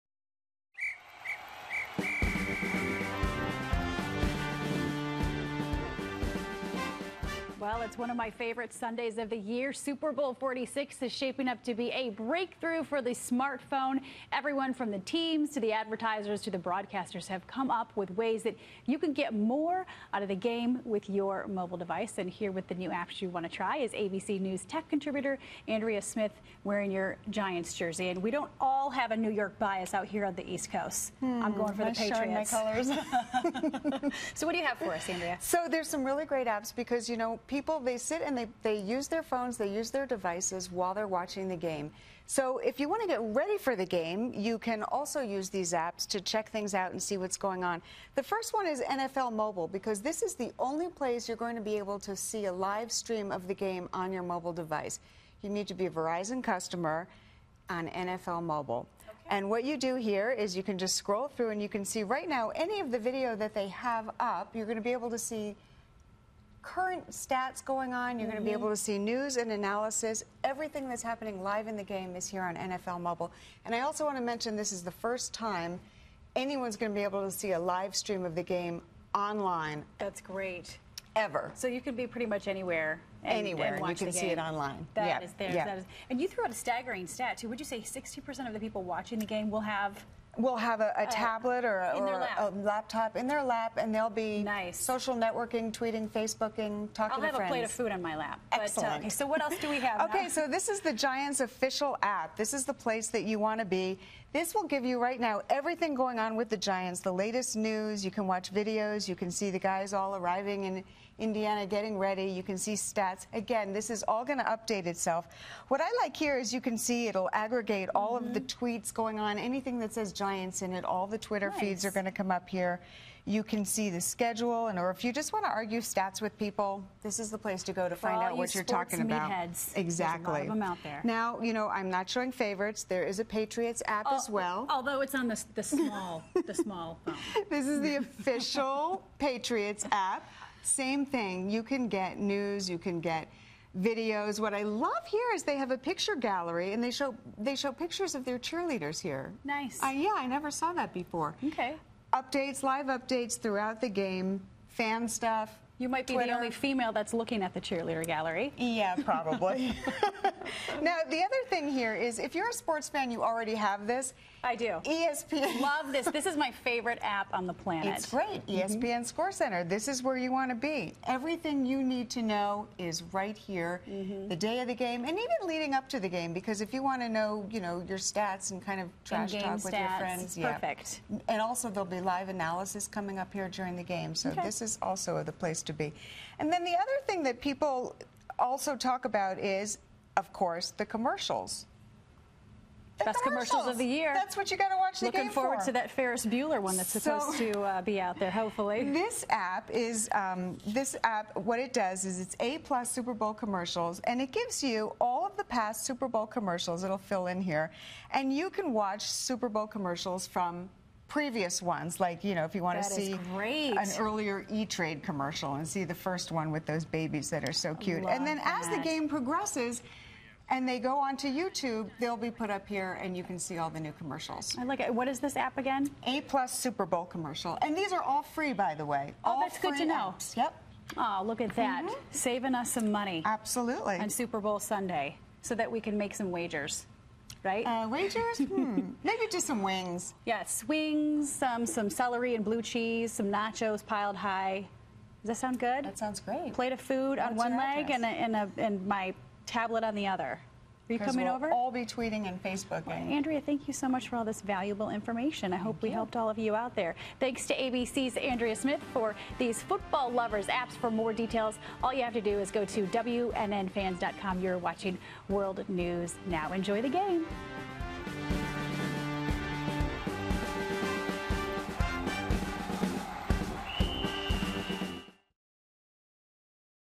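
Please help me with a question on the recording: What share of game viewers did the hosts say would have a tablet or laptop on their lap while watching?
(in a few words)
60%.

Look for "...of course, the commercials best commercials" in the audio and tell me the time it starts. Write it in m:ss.
3:10.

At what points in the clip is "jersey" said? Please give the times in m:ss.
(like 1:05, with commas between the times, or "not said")
0:27.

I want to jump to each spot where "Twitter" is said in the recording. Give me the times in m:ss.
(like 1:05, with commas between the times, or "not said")
2:01, 2:36.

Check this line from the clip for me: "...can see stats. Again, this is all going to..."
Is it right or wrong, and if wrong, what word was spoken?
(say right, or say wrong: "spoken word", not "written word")
right.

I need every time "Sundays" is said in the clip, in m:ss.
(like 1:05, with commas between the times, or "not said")
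0:08, 3:54.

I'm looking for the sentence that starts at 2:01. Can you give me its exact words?
feeds are going to come up here.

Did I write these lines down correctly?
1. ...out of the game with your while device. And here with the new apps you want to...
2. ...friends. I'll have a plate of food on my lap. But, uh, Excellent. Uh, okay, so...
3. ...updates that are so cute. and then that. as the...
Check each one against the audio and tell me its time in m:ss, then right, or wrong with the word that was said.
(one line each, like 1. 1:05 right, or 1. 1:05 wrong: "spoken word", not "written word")
1. 0:20 wrong: "mobile", not "while"
2. 1:36 right
3. 3:36 wrong: "babies", not "updates".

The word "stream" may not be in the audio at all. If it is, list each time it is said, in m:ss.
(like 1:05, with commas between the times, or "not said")
0:52, 1:17.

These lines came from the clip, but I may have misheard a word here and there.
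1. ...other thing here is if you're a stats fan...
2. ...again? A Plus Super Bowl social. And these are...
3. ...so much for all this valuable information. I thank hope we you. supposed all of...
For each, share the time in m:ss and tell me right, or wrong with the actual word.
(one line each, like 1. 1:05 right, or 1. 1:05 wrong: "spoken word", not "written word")
1. 2:41 wrong: "sports", not "stats"
2. 3:45 wrong: "commercial", not "social"
3. 4:13 wrong: "helped", not "supposed".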